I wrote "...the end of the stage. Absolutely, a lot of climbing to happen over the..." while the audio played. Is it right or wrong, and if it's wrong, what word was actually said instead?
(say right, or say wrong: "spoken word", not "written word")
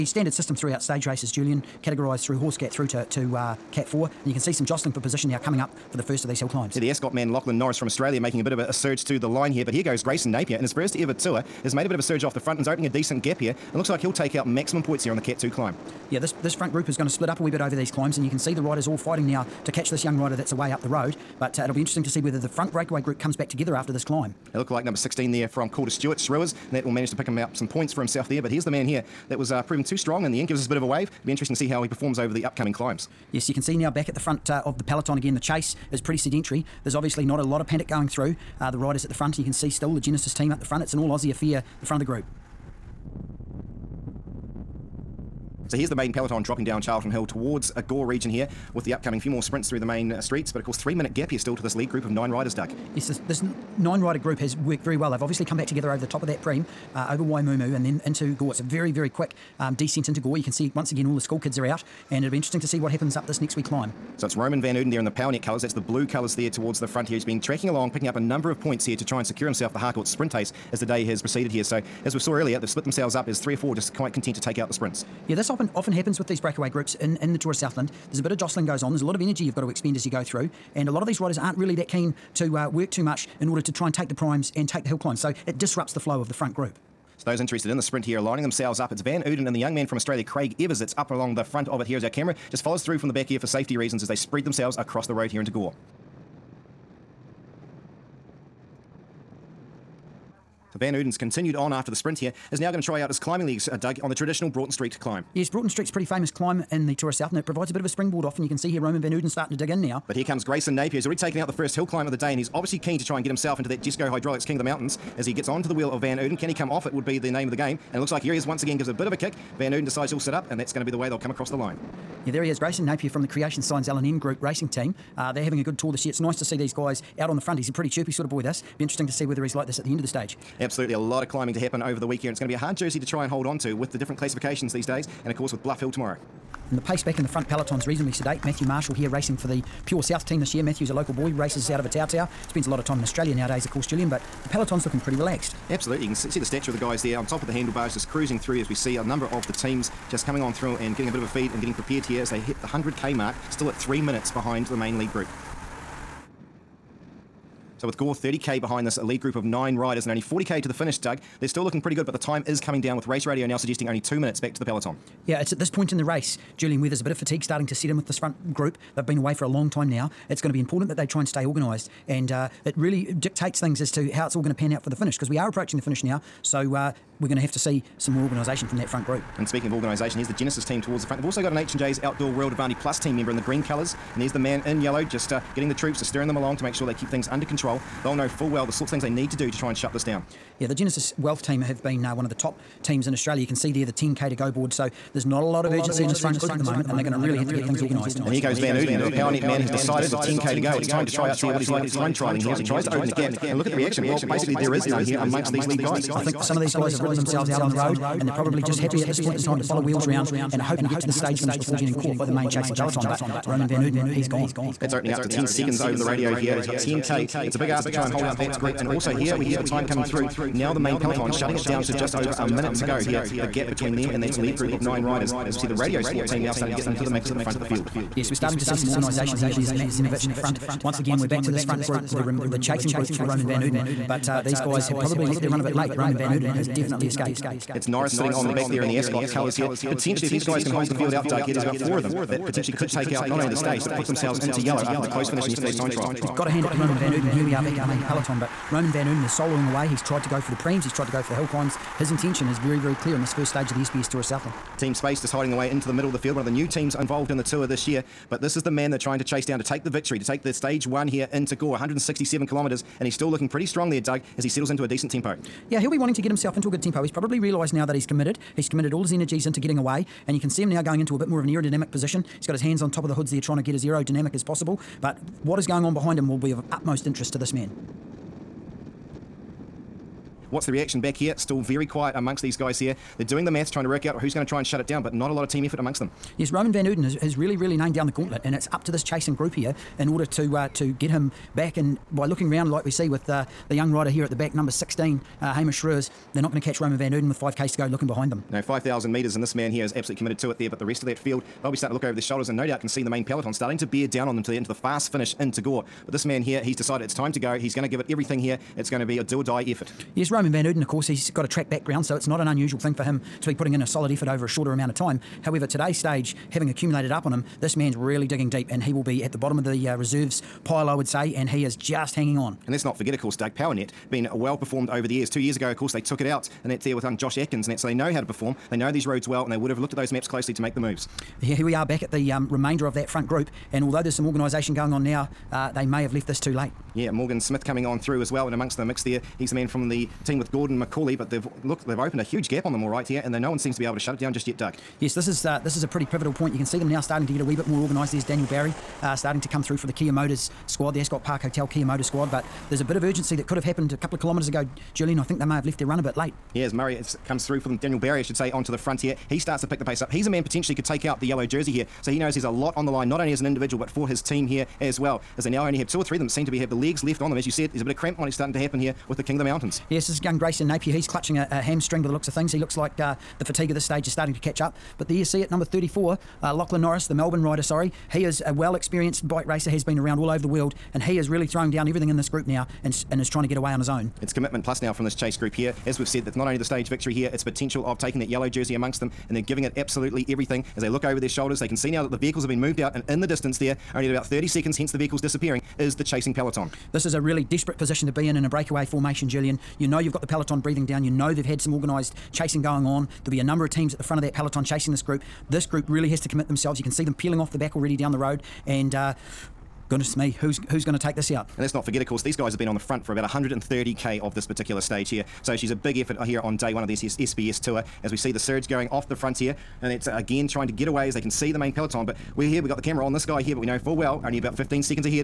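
right.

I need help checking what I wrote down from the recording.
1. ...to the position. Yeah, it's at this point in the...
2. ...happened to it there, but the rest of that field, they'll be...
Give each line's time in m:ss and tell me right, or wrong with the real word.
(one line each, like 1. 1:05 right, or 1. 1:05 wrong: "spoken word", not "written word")
1. 2:44 wrong: "peloton", not "position"
2. 5:00 wrong: "committed", not "happened".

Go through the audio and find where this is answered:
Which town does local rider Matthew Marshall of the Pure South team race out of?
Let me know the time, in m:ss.
2:21.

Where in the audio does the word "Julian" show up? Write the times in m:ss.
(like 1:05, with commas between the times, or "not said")
0:01, 2:23, 2:46, 5:54, 6:39.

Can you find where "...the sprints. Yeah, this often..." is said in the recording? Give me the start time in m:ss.
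1:14.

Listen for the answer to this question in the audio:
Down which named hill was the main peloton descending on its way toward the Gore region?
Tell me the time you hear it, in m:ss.
0:46.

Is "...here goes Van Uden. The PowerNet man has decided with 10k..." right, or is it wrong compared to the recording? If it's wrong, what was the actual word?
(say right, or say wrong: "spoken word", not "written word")
right.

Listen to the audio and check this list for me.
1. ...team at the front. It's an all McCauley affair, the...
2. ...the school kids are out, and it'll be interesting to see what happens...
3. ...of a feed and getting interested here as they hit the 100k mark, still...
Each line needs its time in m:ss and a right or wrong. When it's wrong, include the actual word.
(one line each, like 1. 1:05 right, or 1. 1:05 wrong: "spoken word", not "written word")
1. 0:40 wrong: "Aussie", not "McCauley"
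2. 1:01 right
3. 2:31 wrong: "prepared", not "interested".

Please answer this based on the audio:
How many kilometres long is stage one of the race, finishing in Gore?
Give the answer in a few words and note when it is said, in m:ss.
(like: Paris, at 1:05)
167 kilometres, at 4:21.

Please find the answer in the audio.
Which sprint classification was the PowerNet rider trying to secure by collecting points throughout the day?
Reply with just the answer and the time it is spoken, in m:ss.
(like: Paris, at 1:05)
Harcourt sprint ace, at 1:09.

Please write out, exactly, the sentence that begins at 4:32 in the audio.
He's got his hands on top of the hoods there, trying to get as aerodynamic as possible.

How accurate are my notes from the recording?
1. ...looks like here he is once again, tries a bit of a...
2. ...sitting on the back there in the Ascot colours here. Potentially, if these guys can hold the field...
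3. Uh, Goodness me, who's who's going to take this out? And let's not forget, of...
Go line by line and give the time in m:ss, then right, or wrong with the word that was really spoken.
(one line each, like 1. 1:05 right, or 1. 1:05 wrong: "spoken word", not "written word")
1. 1:58 wrong: "gives", not "tries"
2. 3:58 right
3. 6:48 right.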